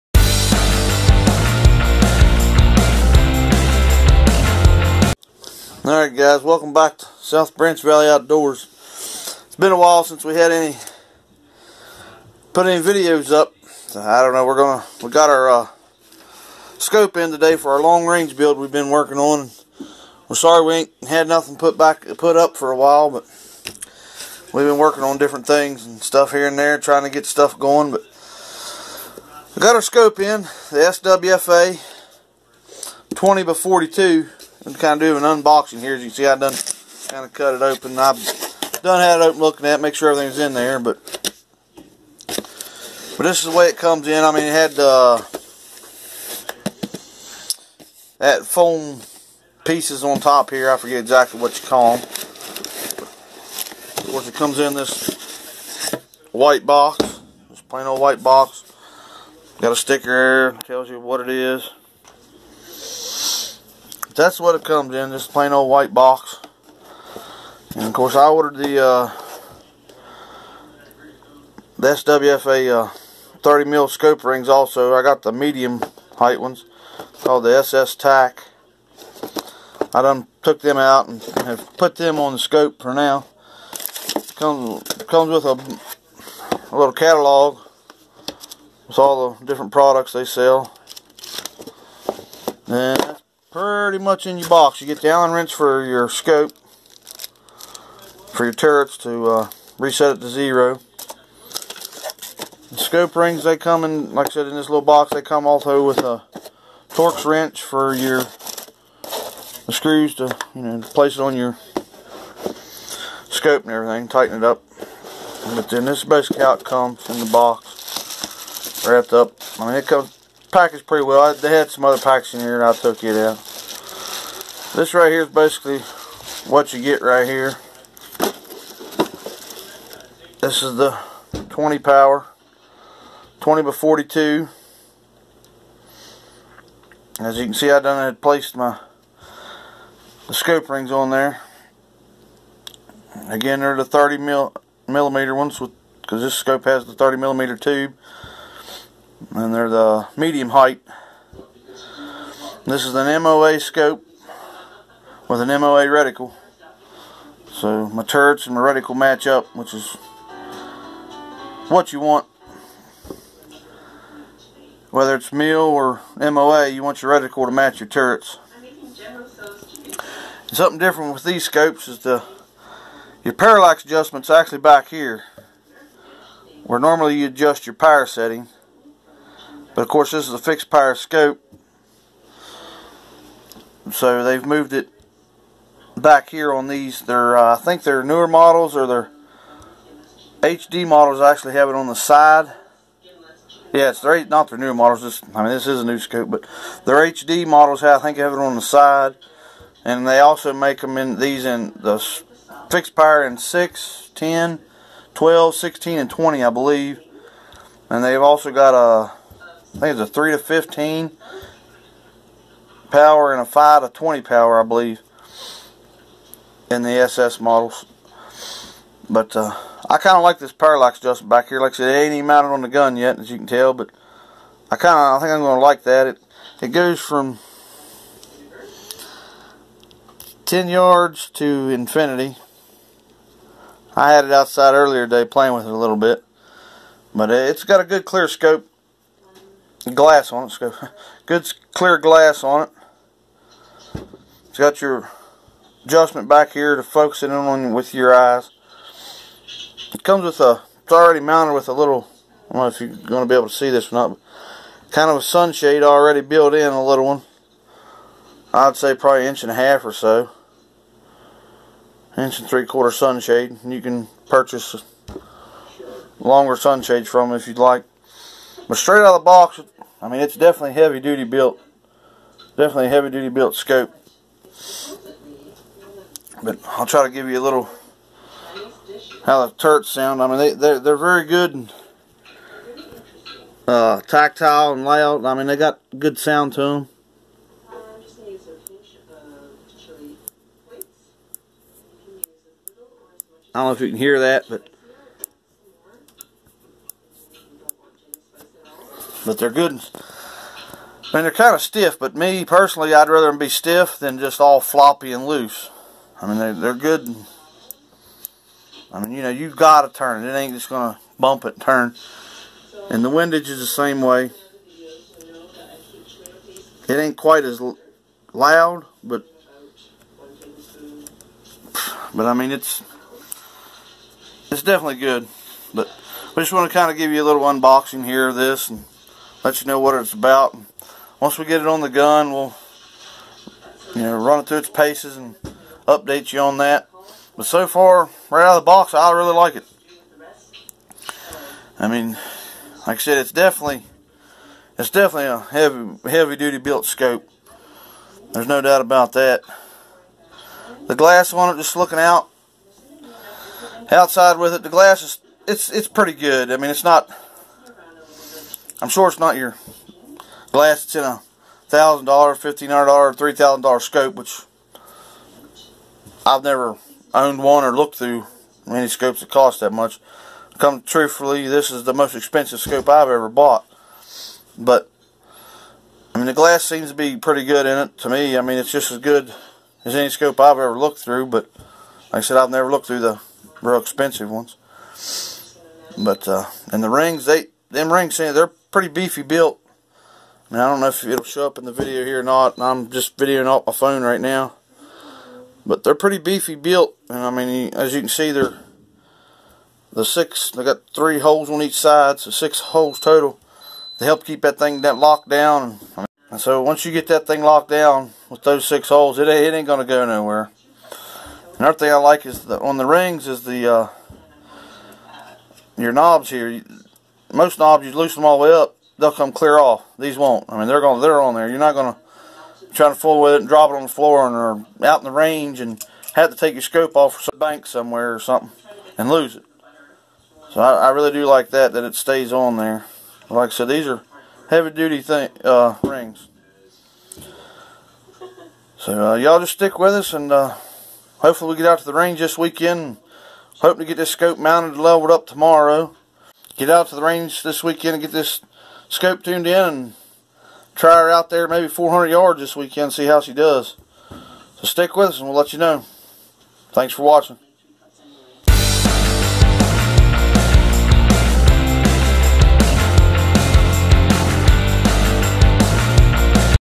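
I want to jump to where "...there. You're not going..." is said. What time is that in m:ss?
7:01.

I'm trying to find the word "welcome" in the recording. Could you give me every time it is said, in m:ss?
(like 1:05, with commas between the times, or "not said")
0:06.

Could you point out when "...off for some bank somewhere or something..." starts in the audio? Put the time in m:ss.
7:06.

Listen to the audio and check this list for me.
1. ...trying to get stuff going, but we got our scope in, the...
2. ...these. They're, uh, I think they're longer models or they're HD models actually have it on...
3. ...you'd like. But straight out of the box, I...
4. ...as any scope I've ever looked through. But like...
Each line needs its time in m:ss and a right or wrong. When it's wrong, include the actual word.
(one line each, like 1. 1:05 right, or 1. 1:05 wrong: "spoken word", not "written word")
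1. 0:26 right
2. 3:06 wrong: "newer", not "longer"
3. 4:27 right
4. 6:19 right.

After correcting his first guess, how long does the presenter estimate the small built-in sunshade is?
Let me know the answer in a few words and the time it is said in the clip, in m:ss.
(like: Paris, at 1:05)
Inch and three quarter, at 4:22.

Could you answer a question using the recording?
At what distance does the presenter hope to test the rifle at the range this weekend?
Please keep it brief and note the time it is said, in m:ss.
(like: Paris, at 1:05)
400 yards, at 7:31.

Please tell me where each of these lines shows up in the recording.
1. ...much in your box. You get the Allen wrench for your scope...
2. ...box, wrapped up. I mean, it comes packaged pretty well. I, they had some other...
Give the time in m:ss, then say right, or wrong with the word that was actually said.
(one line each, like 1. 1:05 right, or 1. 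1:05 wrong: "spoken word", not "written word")
1. 1:33 right
2. 1:57 right.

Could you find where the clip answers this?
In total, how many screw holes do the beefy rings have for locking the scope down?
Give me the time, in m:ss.
6:42.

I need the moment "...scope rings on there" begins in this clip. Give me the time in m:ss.
2:20.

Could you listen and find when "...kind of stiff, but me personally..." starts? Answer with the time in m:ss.
5:01.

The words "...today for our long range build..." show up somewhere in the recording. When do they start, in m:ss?
0:17.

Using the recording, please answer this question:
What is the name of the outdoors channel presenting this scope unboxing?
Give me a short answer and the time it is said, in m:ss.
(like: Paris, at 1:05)
South Branch Valley Outdoors, at 0:07.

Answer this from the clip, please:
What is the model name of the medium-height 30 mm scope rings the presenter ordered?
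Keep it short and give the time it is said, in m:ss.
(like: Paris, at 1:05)
SS TAC, at 1:17.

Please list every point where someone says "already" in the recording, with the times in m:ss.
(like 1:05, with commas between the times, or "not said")
4:10, 4:15.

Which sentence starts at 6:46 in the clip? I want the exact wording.
And so once you get that thing locked down with those six holes, it, it ain't going to go nowhere.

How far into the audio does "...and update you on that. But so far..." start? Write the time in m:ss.
5:35.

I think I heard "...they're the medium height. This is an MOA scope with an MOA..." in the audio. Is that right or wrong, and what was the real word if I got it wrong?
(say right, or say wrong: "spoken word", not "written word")
right.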